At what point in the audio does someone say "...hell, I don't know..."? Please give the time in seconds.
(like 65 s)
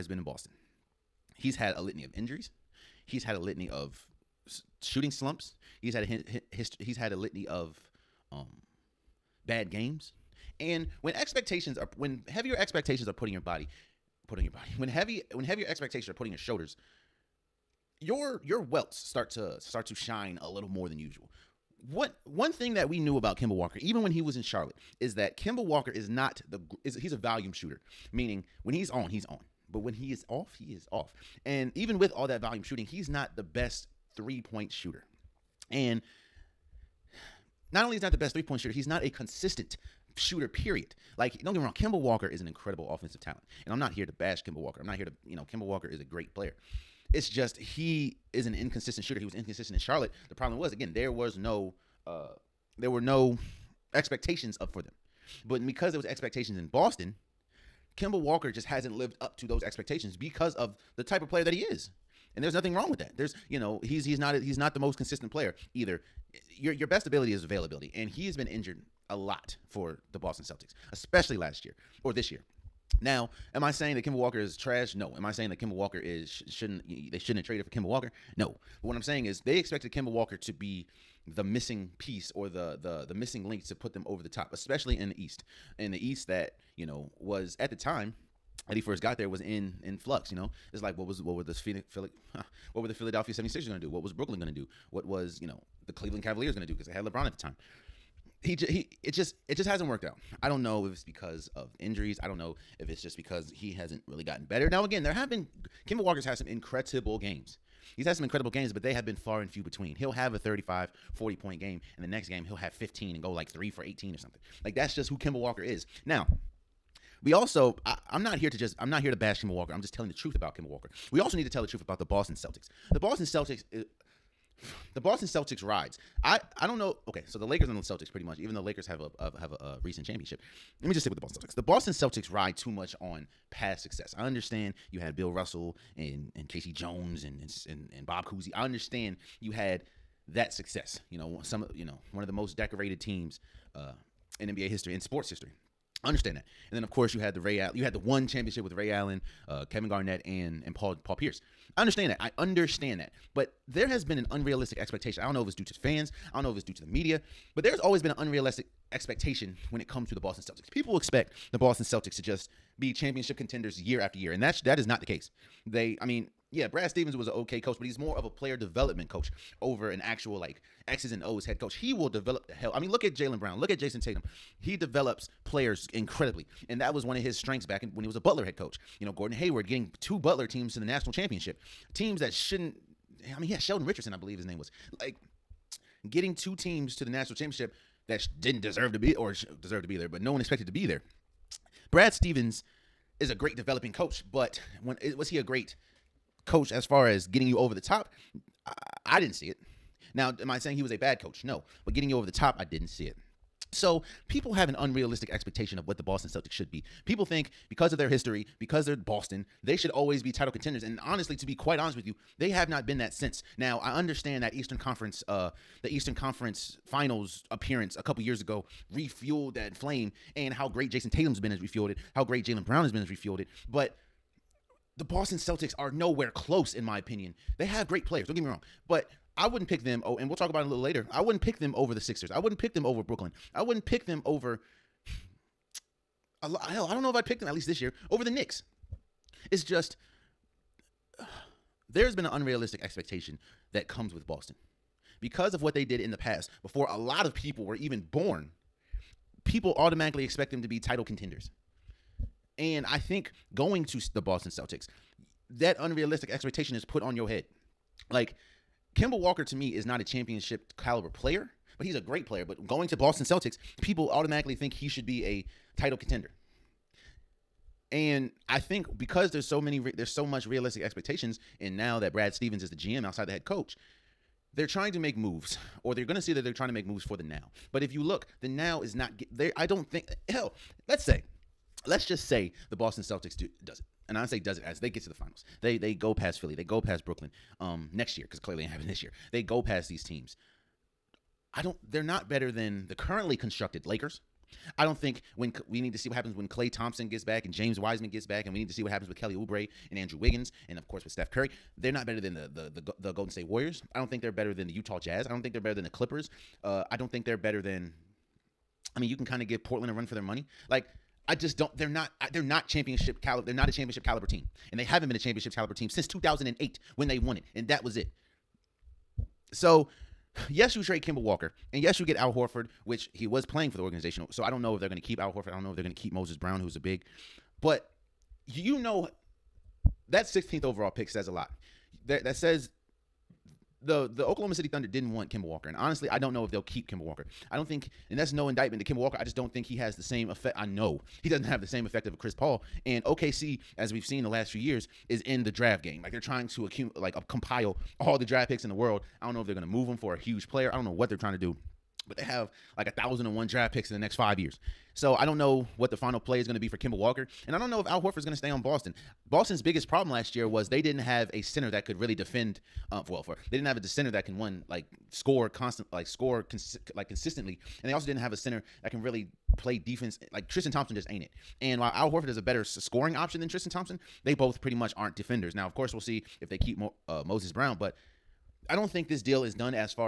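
236 s.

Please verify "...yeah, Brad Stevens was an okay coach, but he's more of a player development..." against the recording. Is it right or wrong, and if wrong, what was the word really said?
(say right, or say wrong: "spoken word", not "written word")
right.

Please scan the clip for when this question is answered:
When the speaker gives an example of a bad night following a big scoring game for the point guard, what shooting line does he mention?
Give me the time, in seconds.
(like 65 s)
113 s.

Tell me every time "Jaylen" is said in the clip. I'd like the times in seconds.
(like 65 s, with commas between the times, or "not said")
173 s, 222 s.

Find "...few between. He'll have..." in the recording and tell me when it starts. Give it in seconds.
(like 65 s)
109 s.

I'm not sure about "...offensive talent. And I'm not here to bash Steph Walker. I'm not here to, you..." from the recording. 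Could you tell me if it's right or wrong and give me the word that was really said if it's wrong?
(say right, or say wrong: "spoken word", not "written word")
wrong: "Kemba", not "Steph".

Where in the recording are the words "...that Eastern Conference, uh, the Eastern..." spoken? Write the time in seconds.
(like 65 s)
214 s.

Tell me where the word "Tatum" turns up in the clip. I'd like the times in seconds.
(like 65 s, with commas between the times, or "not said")
174 s, 221 s.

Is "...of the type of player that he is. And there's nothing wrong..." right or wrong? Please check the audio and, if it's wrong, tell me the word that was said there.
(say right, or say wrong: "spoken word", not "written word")
right.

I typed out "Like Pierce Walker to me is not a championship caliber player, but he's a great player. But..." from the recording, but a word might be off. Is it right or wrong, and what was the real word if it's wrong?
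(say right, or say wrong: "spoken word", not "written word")
wrong: "Kemba", not "Pierce".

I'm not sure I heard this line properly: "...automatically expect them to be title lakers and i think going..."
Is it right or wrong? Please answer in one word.
wrong.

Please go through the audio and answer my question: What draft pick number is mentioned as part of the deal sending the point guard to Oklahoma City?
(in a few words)
16th overall.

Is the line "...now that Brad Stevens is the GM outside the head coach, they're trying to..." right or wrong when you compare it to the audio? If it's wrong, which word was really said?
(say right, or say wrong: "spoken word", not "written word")
right.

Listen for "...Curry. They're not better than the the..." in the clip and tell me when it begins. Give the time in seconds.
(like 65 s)
301 s.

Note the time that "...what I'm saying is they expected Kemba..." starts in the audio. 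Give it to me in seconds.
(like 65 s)
78 s.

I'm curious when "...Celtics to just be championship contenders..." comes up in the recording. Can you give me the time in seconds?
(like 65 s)
161 s.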